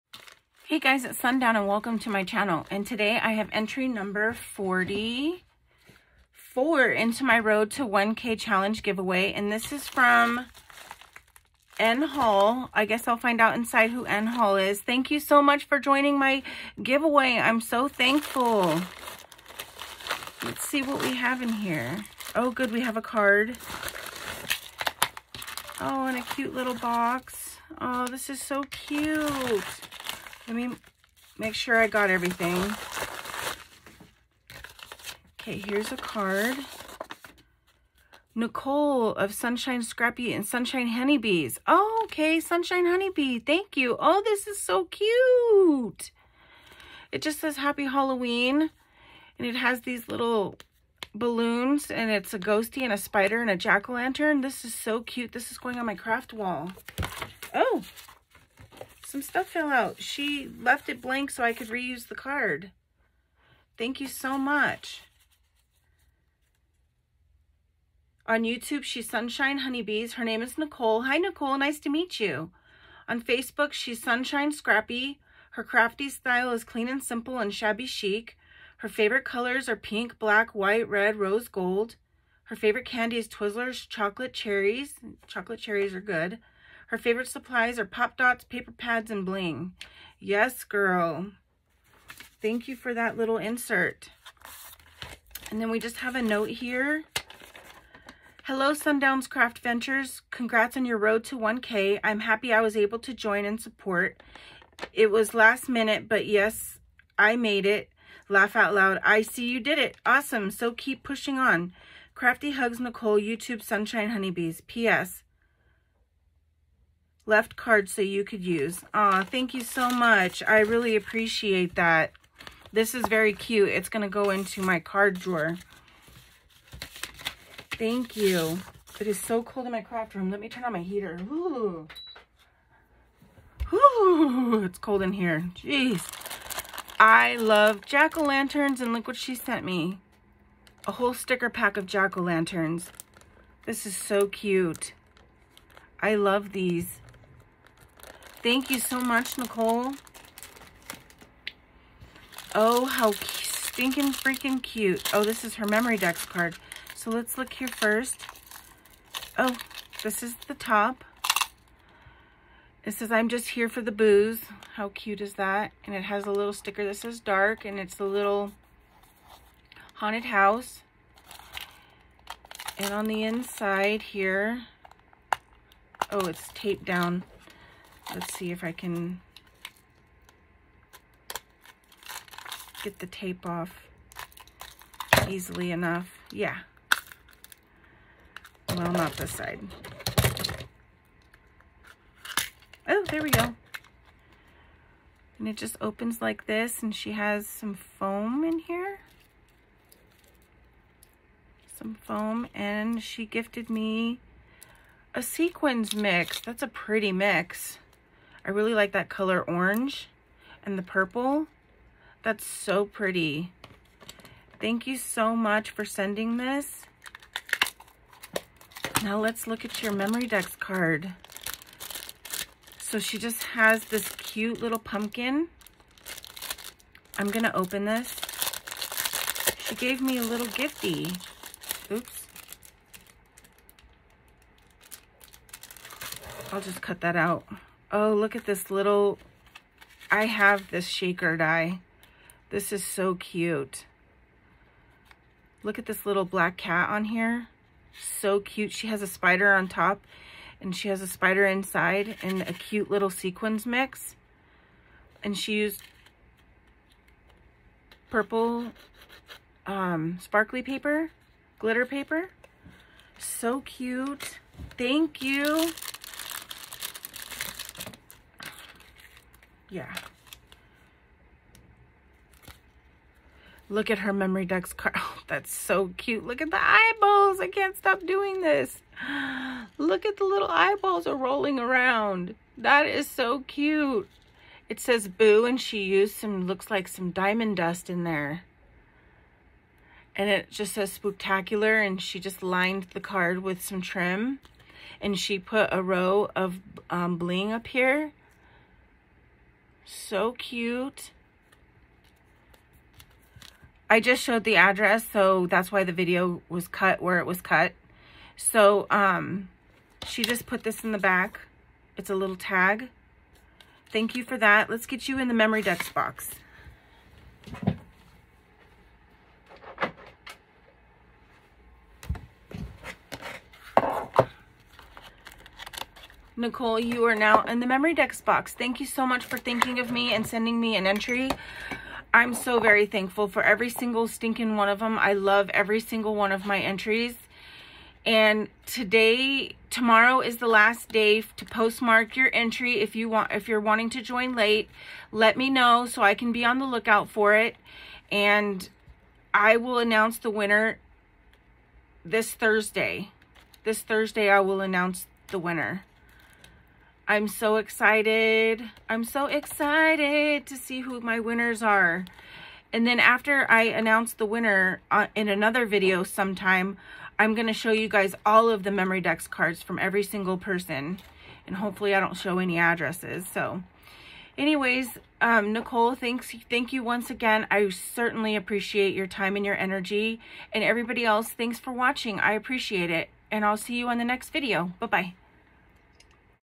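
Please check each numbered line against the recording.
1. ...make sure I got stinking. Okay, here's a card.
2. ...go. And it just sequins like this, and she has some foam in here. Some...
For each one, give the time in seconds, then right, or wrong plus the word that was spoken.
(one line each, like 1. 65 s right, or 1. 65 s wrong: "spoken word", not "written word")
1. 31 s wrong: "everything", not "stinking"
2. 193 s wrong: "opens", not "sequins".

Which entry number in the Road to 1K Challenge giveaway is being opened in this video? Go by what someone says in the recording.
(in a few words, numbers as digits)
44.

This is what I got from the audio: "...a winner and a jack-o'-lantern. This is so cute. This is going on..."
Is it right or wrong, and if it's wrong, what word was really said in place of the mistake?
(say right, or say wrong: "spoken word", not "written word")
wrong: "spider", not "winner".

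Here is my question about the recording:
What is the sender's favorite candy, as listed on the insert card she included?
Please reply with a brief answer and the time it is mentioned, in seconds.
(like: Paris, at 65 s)
Twizzlers chocolate cherries, at 83 s.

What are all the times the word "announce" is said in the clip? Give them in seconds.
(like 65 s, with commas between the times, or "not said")
349 s, 354 s, 363 s.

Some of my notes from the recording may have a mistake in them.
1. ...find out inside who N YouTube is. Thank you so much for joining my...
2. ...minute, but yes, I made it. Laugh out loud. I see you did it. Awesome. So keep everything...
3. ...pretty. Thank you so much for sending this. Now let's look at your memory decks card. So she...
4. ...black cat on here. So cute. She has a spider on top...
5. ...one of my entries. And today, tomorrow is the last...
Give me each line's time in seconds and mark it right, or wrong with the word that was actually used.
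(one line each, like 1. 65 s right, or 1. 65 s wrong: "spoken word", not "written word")
1. 13 s wrong: "Hall", not "YouTube"
2. 105 s wrong: "pushing", not "everything"
3. 212 s right
4. 246 s right
5. 336 s right.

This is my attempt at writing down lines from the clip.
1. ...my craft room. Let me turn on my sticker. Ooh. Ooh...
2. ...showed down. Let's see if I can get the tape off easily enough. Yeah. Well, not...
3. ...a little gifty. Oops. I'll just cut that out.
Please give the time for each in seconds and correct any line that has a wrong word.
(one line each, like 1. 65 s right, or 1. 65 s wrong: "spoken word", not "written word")
1. 129 s wrong: "heater", not "sticker"
2. 176 s wrong: "taped", not "showed"
3. 230 s right.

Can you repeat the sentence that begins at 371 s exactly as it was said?
And hopefully I don't show any addresses.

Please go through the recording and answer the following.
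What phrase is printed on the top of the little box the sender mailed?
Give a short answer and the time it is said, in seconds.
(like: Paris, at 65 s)
I'm just here for the booze, at 163 s.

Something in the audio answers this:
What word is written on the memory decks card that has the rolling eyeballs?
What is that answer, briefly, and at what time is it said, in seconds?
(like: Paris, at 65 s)
Boo, at 285 s.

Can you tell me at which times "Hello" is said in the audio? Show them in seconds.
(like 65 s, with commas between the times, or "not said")
98 s.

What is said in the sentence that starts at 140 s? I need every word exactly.
A whole sticker pack of jack-o'-lanterns.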